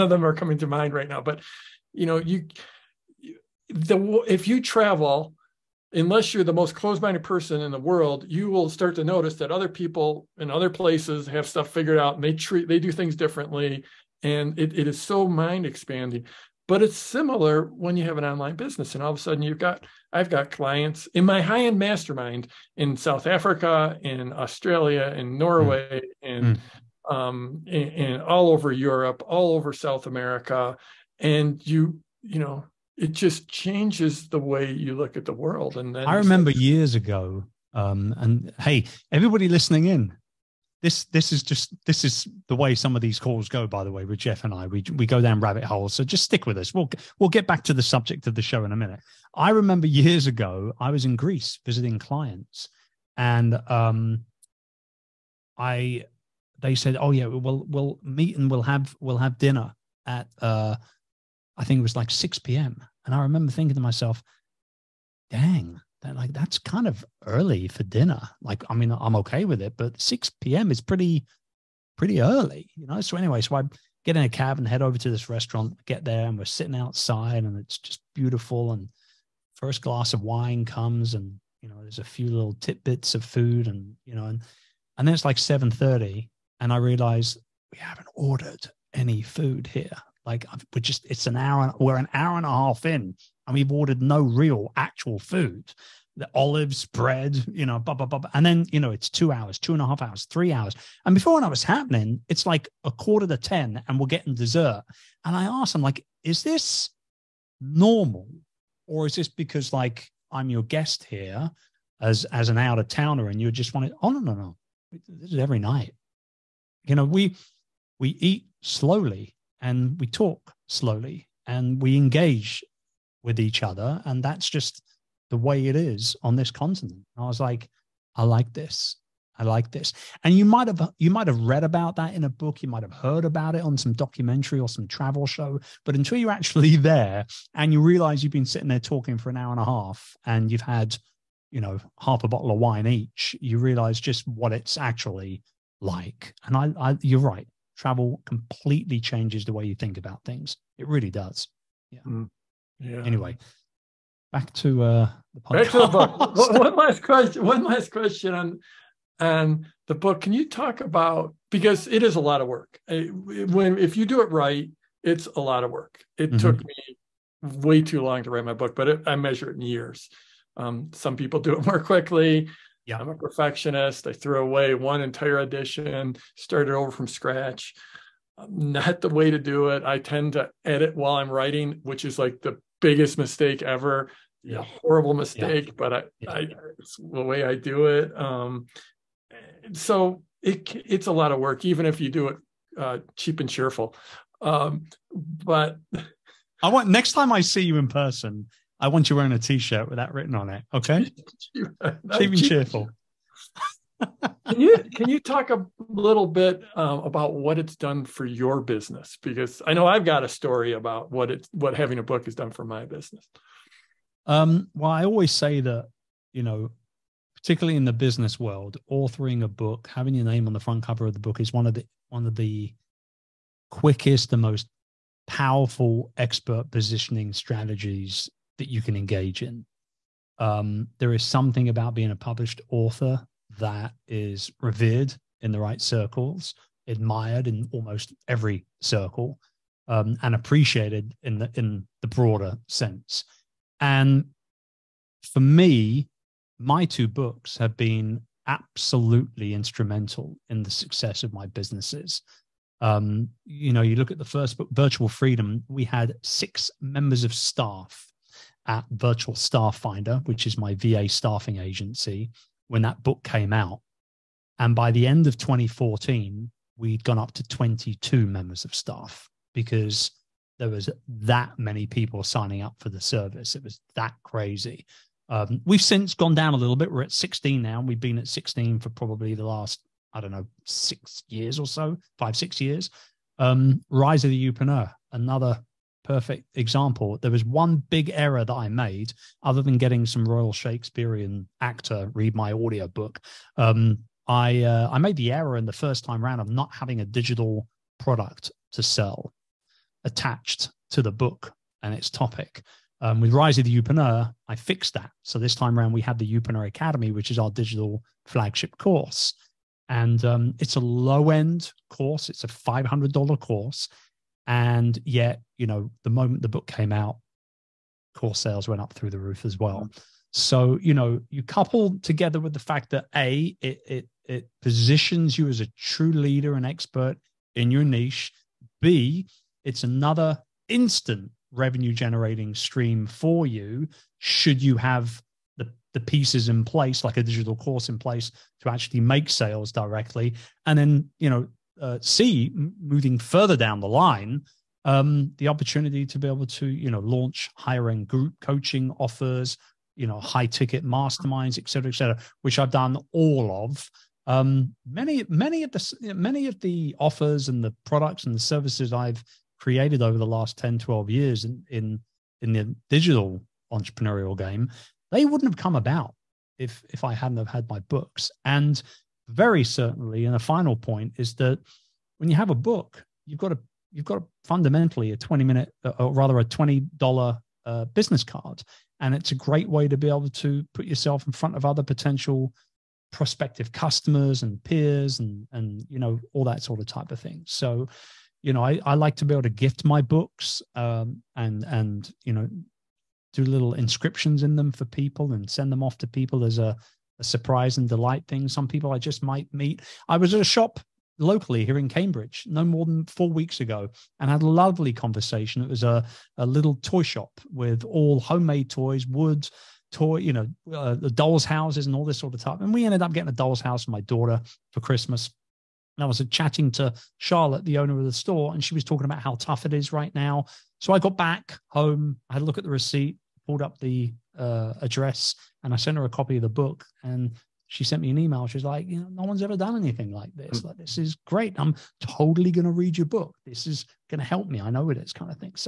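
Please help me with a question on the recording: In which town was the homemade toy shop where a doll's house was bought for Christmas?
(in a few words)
Cambridge.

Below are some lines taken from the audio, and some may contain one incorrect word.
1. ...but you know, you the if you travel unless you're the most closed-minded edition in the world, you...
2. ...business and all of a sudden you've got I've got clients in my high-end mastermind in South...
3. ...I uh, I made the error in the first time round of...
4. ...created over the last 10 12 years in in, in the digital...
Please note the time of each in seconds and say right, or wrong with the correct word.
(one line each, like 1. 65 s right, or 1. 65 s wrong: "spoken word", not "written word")
1. 1 s wrong: "person", not "edition"
2. 18 s right
3. 294 s right
4. 359 s right.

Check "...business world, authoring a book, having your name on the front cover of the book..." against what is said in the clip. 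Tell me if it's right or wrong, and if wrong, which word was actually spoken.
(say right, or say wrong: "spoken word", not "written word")
right.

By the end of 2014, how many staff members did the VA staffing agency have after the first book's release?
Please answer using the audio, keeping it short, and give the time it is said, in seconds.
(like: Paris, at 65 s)
22, at 267 s.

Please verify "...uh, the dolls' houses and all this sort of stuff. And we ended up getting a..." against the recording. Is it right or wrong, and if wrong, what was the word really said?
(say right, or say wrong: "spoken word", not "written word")
right.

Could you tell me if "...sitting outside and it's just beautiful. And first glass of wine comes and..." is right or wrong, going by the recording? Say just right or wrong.
right.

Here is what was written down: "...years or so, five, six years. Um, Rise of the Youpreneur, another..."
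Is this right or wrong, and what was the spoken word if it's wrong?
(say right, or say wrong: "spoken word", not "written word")
right.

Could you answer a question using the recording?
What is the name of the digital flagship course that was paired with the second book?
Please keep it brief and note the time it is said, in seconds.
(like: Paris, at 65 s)
Youpreneur Academy, at 306 s.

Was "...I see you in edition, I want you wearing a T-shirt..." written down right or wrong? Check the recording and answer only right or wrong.
wrong.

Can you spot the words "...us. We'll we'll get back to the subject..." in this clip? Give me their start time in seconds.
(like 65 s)
46 s.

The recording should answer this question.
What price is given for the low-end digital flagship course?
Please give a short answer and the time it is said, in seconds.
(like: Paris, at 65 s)
$500, at 312 s.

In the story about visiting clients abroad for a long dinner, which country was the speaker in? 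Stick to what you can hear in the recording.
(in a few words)
Greece.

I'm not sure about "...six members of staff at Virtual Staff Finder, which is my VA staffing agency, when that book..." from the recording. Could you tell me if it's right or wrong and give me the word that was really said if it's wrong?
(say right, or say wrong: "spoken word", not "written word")
right.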